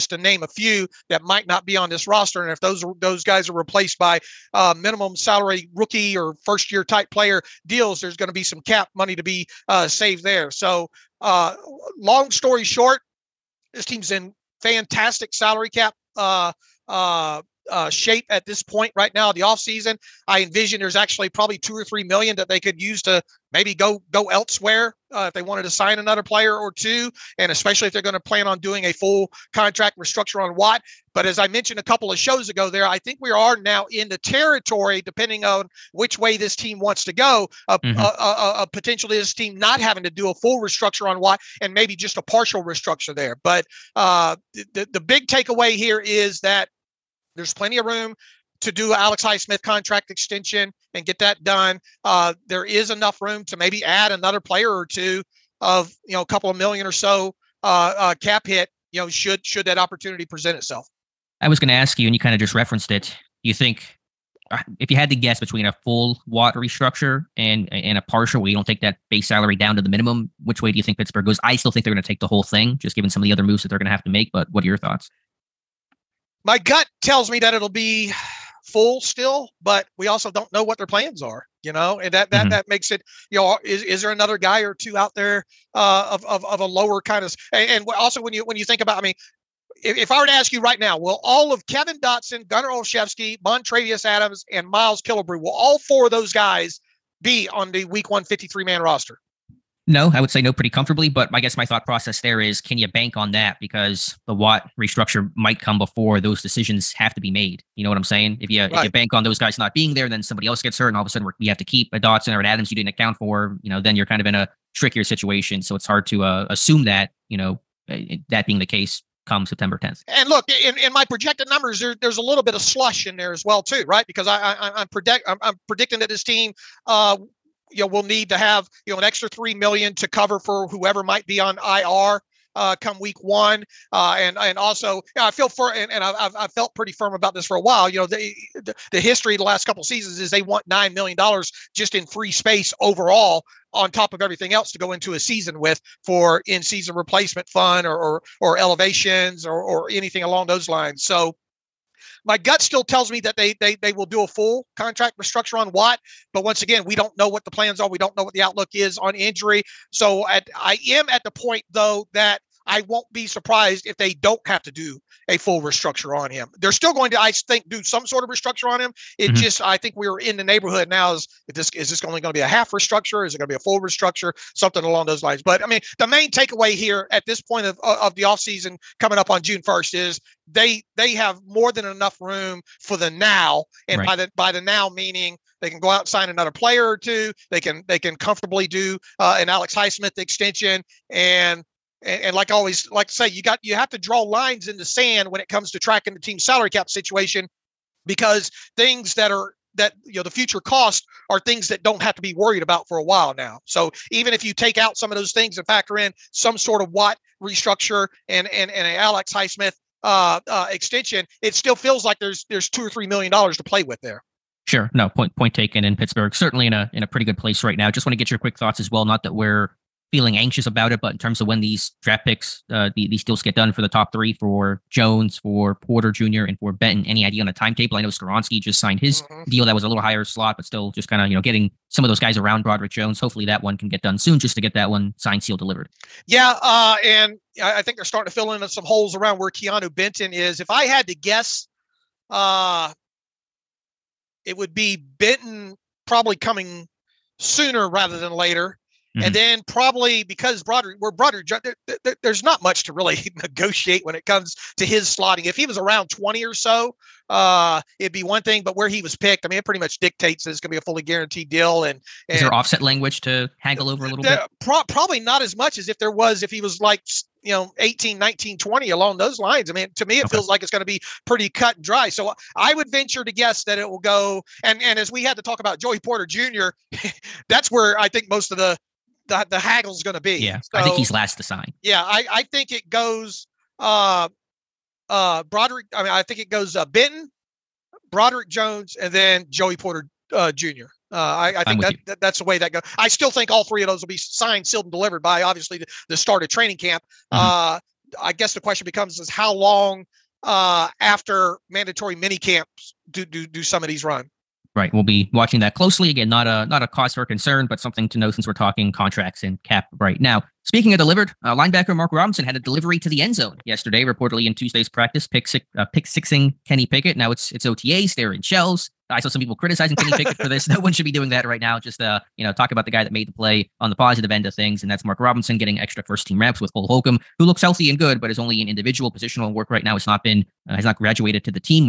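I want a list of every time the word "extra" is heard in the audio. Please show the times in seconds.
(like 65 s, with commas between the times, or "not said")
129 s, 325 s.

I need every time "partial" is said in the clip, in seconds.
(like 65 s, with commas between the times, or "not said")
42 s, 68 s.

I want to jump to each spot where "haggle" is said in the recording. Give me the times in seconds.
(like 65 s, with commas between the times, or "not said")
263 s, 279 s.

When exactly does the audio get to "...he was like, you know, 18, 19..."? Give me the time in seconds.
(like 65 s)
266 s.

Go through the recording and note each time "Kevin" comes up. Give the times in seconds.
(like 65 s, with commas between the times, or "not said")
91 s.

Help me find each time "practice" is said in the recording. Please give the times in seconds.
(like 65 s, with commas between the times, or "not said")
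314 s.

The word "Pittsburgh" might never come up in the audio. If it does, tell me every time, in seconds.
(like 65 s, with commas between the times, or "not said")
70 s, 215 s.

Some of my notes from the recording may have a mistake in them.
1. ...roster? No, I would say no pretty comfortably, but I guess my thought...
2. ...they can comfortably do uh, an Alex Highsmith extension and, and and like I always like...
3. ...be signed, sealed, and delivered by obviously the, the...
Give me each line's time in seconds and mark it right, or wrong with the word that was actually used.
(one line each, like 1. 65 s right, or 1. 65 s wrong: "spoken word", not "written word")
1. 98 s right
2. 187 s right
3. 294 s right.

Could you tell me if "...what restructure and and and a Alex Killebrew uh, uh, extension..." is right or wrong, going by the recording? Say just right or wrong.
wrong.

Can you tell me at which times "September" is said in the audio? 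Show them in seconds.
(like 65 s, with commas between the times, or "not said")
119 s.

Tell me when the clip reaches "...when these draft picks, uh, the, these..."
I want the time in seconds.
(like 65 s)
221 s.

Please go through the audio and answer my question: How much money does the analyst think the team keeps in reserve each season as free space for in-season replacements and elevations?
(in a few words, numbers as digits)
9 million dollars.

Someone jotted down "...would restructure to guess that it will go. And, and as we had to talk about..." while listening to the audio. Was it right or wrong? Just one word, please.
wrong.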